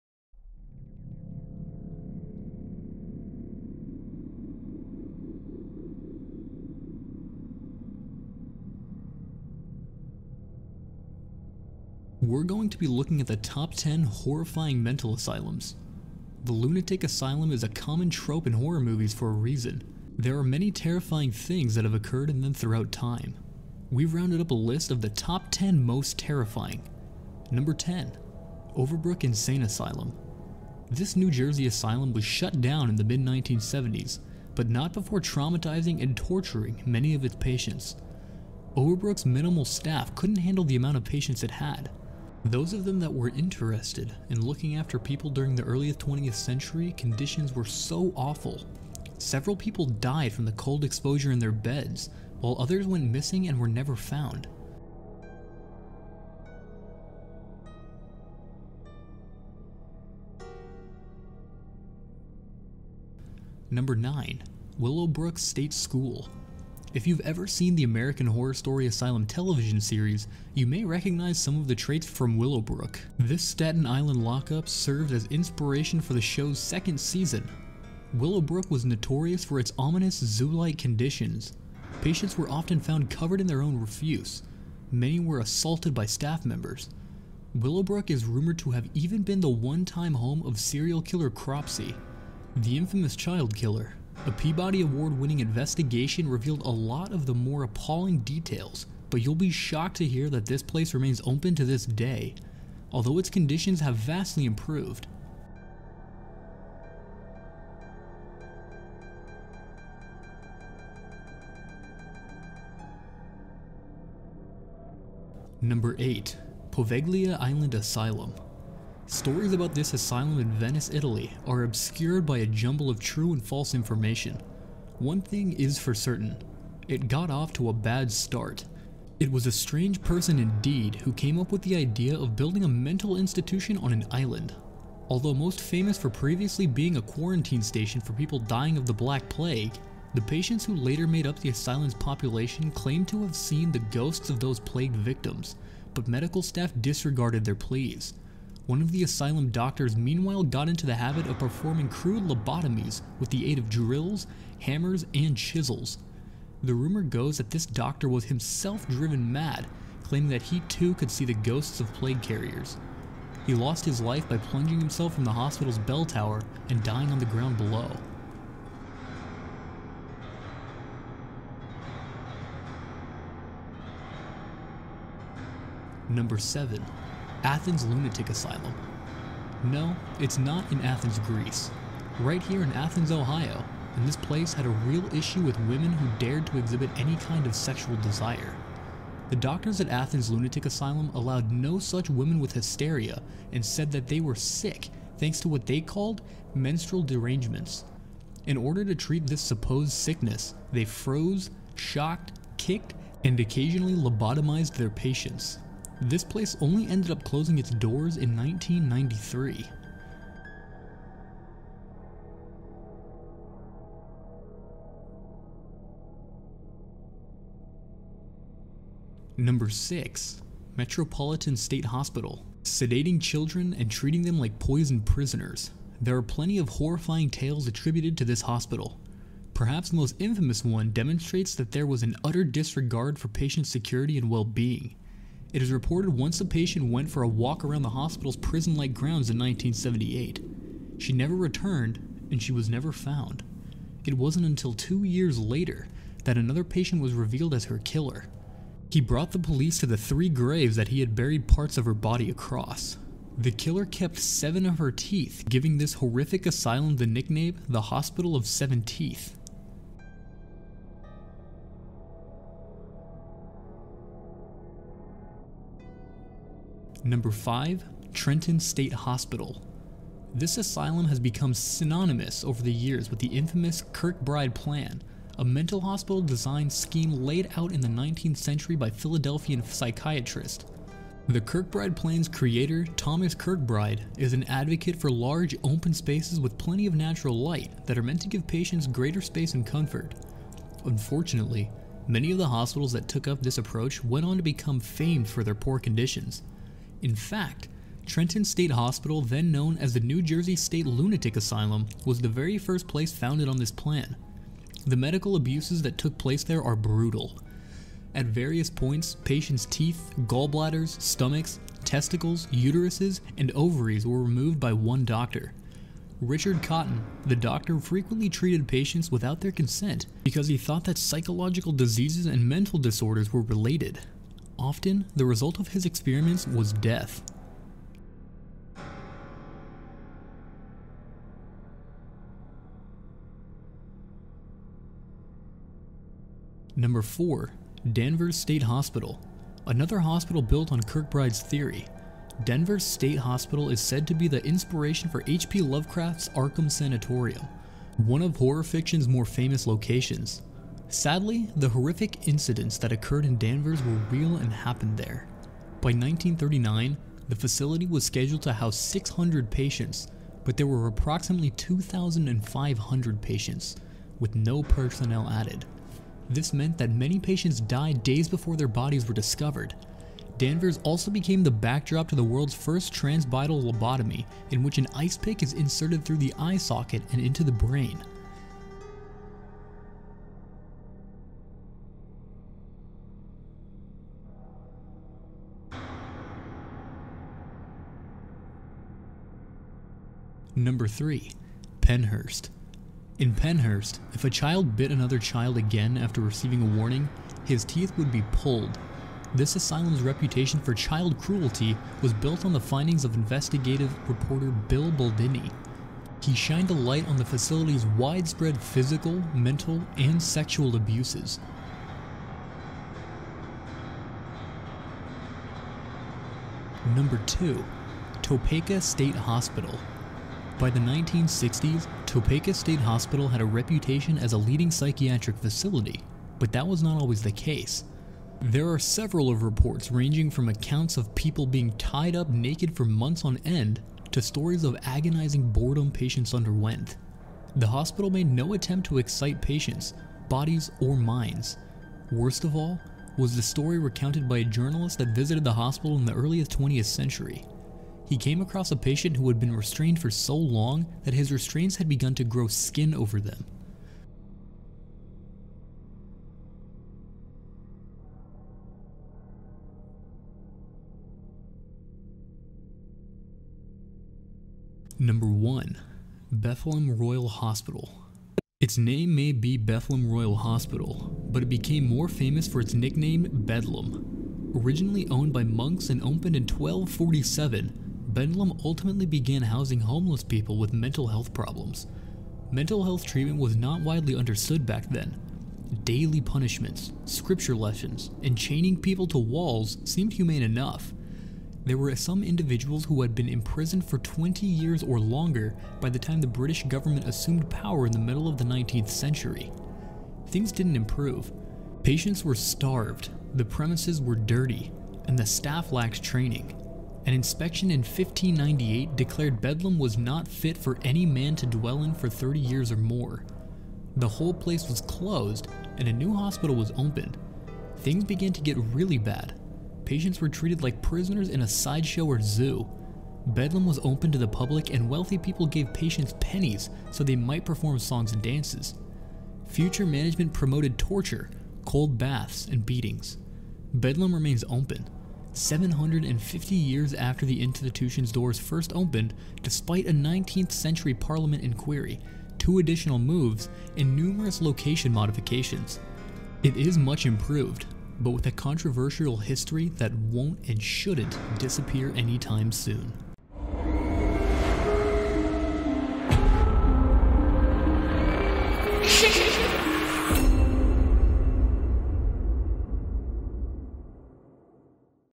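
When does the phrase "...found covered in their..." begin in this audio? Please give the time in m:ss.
1:22.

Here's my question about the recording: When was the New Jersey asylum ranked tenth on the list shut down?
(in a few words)
mid-1970s.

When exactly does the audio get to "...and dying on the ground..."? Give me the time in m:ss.
2:46.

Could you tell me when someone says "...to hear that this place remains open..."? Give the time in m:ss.
1:39.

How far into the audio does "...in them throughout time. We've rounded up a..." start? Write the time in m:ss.
0:22.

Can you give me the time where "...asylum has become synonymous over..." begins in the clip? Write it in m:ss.
4:30.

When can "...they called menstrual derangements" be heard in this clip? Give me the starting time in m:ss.
3:15.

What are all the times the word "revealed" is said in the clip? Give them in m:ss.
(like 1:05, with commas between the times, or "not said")
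1:36, 4:07.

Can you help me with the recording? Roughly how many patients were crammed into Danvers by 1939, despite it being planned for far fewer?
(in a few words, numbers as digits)
2,500.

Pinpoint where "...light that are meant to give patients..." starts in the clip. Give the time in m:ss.
4:47.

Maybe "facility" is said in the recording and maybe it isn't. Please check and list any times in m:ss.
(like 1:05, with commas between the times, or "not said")
5:57, 6:47, 7:05.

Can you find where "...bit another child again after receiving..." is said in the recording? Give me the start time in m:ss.
6:34.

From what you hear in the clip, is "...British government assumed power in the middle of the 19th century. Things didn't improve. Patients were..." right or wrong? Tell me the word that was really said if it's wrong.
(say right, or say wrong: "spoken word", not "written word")
right.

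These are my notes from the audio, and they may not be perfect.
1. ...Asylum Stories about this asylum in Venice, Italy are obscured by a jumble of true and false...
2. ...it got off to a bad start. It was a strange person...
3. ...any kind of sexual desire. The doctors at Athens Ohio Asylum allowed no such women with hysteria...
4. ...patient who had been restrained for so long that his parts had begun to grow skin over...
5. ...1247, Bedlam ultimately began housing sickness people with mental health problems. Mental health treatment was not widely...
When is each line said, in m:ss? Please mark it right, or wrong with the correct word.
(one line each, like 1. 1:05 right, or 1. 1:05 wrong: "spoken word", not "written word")
1. 1:57 right
2. 2:06 right
3. 3:06 wrong: "Lunatic", not "Ohio"
4. 7:28 wrong: "restraints", not "parts"
5. 7:56 wrong: "homeless", not "sickness".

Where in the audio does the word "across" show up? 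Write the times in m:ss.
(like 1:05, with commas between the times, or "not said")
4:12, 7:28.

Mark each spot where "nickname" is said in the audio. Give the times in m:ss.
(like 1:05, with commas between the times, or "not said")
4:17, 7:52.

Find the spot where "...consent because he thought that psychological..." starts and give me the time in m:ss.
5:19.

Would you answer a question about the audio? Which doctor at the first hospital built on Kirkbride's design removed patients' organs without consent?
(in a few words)
Richard Cotton.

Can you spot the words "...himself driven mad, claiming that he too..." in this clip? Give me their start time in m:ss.
2:38.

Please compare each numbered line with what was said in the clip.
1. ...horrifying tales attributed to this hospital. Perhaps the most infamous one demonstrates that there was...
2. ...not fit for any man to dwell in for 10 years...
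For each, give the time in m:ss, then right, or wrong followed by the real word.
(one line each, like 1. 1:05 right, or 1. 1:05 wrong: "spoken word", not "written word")
1. 3:46 right
2. 8:29 wrong: "30", not "10".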